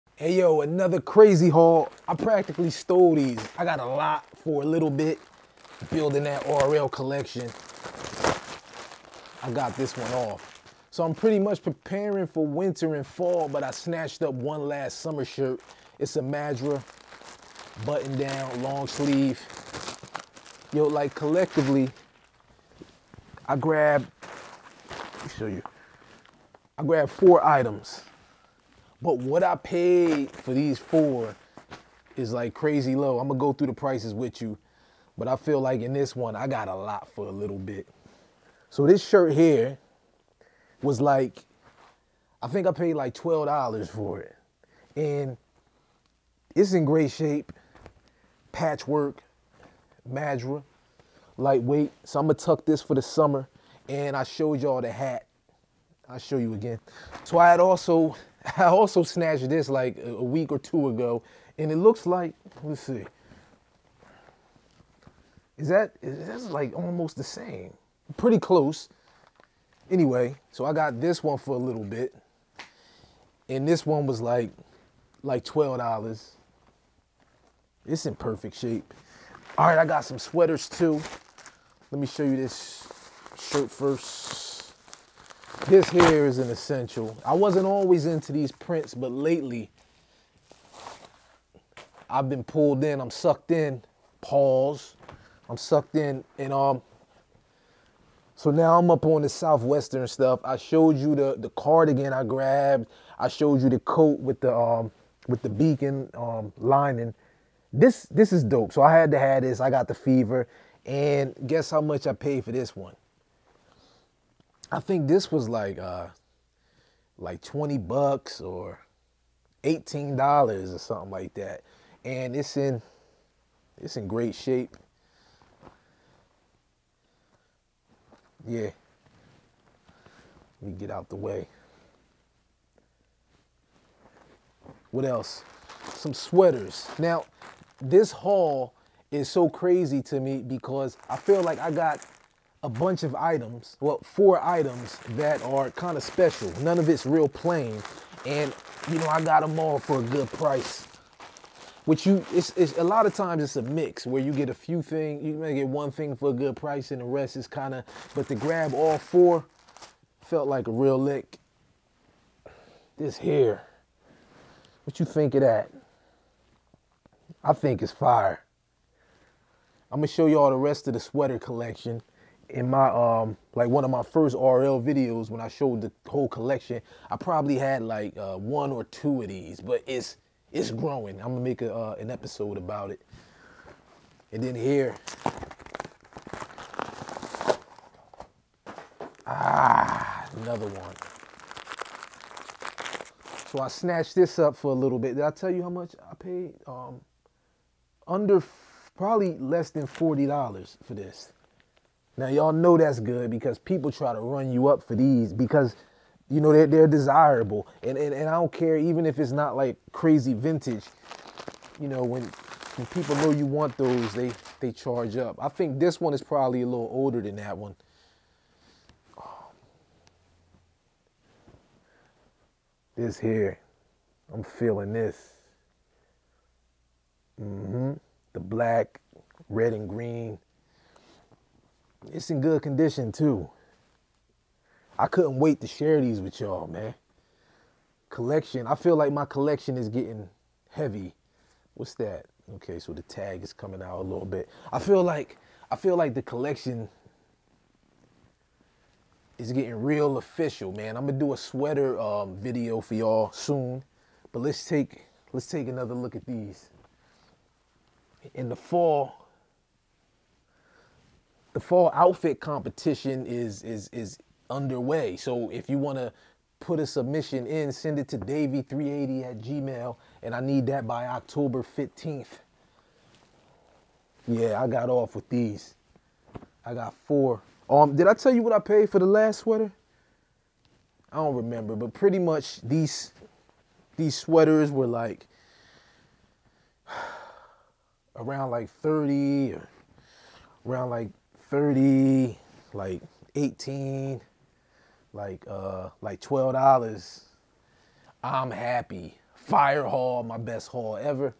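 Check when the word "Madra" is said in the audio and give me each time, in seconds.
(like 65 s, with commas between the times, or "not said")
16 s, 50 s.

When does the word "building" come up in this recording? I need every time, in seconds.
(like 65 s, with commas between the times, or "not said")
5 s.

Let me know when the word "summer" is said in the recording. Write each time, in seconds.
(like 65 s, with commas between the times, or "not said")
14 s, 53 s.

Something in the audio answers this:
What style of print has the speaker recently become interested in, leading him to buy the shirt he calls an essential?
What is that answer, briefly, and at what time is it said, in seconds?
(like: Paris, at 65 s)
Southwestern, at 99 s.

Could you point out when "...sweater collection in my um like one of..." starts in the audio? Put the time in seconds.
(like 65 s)
170 s.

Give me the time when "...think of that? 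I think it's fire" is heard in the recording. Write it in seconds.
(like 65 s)
165 s.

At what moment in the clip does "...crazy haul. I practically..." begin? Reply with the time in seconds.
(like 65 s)
1 s.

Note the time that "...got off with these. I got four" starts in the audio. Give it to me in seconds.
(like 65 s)
274 s.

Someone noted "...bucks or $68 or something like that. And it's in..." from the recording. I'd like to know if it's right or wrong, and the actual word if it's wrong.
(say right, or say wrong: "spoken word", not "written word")
wrong: "18", not "68".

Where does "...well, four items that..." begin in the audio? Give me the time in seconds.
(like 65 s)
143 s.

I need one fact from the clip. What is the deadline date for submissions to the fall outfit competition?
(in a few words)
October 15th.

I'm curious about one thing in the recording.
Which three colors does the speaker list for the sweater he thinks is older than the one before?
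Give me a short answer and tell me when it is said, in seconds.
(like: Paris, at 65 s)
Black, red and green, at 228 s.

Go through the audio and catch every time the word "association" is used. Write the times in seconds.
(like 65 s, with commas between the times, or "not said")
not said.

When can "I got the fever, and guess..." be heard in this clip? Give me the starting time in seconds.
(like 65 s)
109 s.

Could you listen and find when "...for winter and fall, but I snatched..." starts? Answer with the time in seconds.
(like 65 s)
12 s.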